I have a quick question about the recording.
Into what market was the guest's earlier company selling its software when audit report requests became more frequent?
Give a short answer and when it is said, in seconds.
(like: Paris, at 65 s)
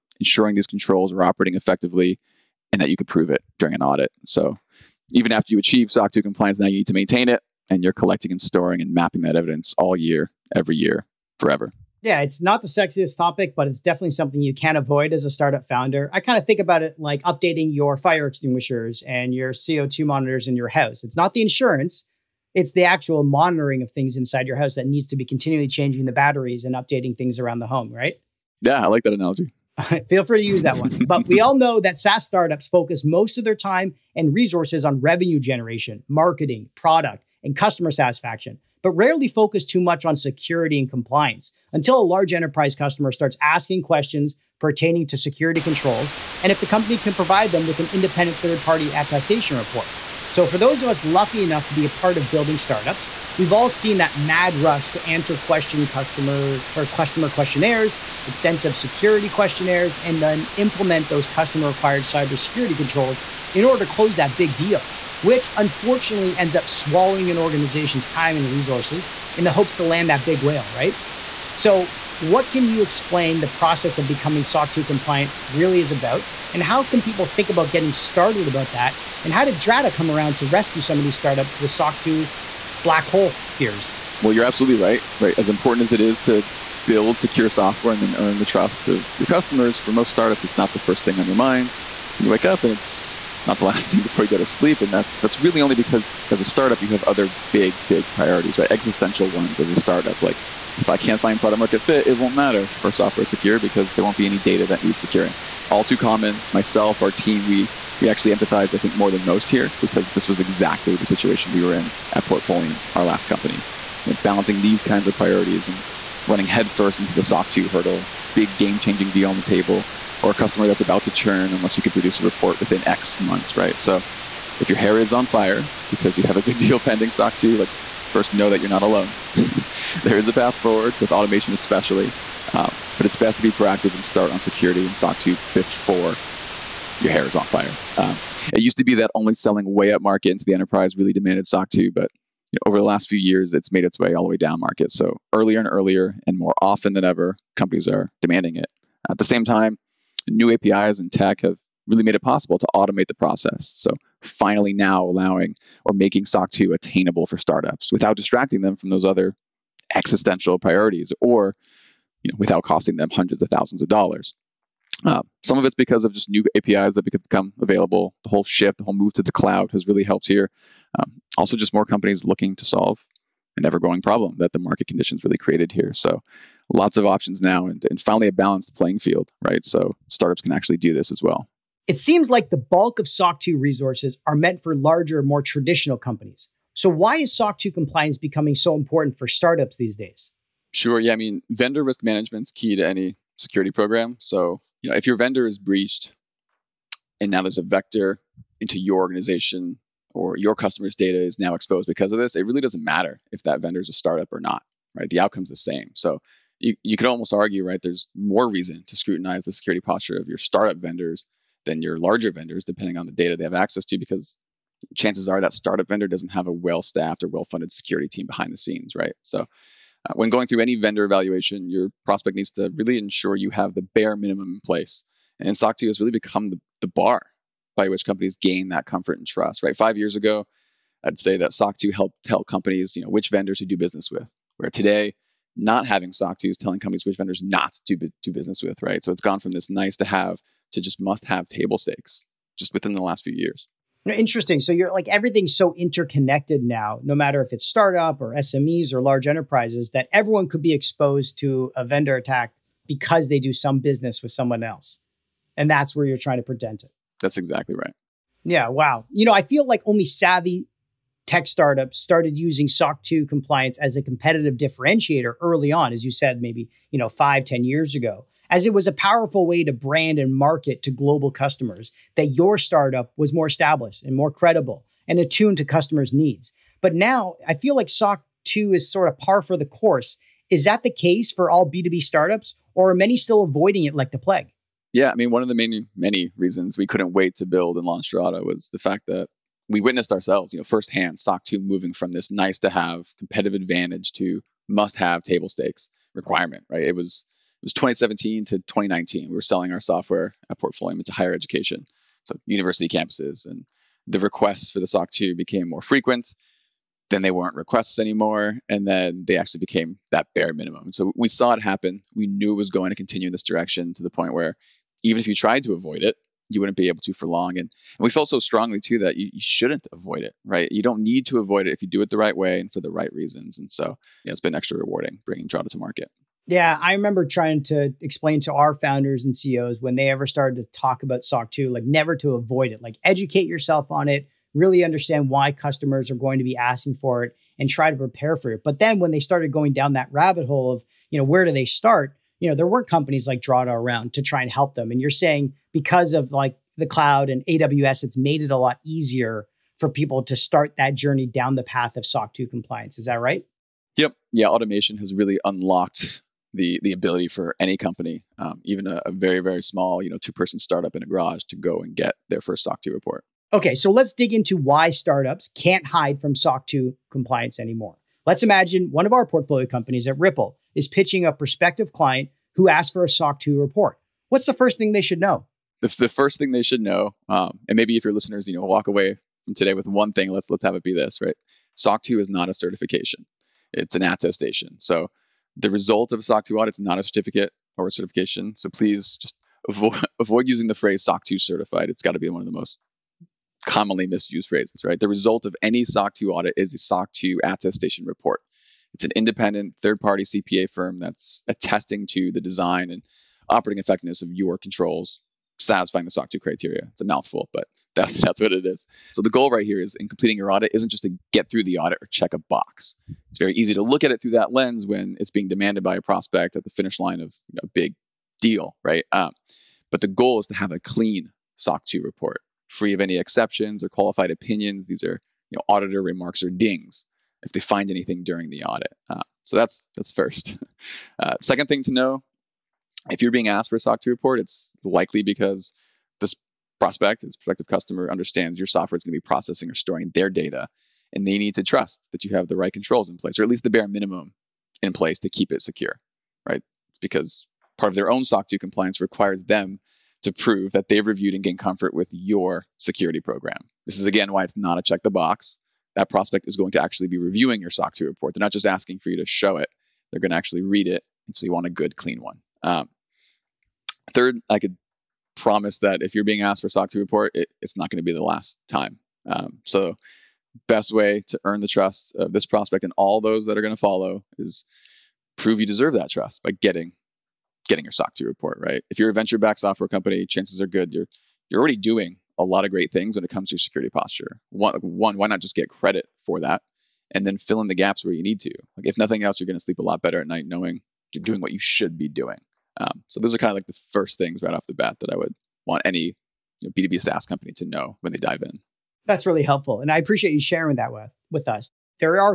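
higher education, at 301 s.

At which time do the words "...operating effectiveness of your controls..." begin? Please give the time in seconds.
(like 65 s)
403 s.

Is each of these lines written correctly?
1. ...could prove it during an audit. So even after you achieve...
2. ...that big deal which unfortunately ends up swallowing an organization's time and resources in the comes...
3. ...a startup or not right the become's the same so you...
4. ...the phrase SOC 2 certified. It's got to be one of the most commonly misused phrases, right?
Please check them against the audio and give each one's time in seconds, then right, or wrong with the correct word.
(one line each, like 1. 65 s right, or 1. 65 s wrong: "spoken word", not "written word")
1. 2 s right
2. 64 s wrong: "hopes", not "comes"
3. 203 s wrong: "outcome", not "become"
4. 390 s right.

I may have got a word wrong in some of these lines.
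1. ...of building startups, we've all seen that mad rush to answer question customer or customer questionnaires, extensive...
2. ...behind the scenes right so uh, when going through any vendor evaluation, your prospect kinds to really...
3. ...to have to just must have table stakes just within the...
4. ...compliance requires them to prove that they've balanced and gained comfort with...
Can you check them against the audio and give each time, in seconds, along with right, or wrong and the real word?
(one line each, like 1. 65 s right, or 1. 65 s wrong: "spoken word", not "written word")
1. 52 s right
2. 218 s wrong: "needs", not "kinds"
3. 239 s right
4. 448 s wrong: "reviewed", not "balanced".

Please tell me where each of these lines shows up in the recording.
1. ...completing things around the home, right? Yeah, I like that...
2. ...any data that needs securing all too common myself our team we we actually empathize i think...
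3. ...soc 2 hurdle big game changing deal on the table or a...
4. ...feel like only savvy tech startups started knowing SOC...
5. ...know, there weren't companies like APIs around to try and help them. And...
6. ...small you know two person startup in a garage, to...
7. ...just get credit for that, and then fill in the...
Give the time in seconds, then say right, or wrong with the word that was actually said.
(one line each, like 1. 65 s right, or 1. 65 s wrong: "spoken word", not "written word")
1. 26 s wrong: "updating", not "completing"
2. 104 s right
3. 117 s right
4. 259 s wrong: "using", not "knowing"
5. 342 s wrong: "Drata", not "APIs"
6. 359 s right
7. 485 s right.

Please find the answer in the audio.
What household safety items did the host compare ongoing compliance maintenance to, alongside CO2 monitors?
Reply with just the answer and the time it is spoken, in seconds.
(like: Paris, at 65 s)
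fire extinguishers, at 17 s.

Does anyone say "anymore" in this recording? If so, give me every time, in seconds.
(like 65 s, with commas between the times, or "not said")
307 s, 367 s.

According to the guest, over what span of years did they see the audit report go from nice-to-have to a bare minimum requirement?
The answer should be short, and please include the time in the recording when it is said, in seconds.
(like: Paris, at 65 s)
2017 to 2019, at 297 s.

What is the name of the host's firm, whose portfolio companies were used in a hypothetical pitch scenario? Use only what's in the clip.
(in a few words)
Ripple.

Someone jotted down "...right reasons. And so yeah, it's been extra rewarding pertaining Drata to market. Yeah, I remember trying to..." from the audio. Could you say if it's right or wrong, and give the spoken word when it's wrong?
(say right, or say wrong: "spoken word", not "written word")
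wrong: "bringing", not "pertaining".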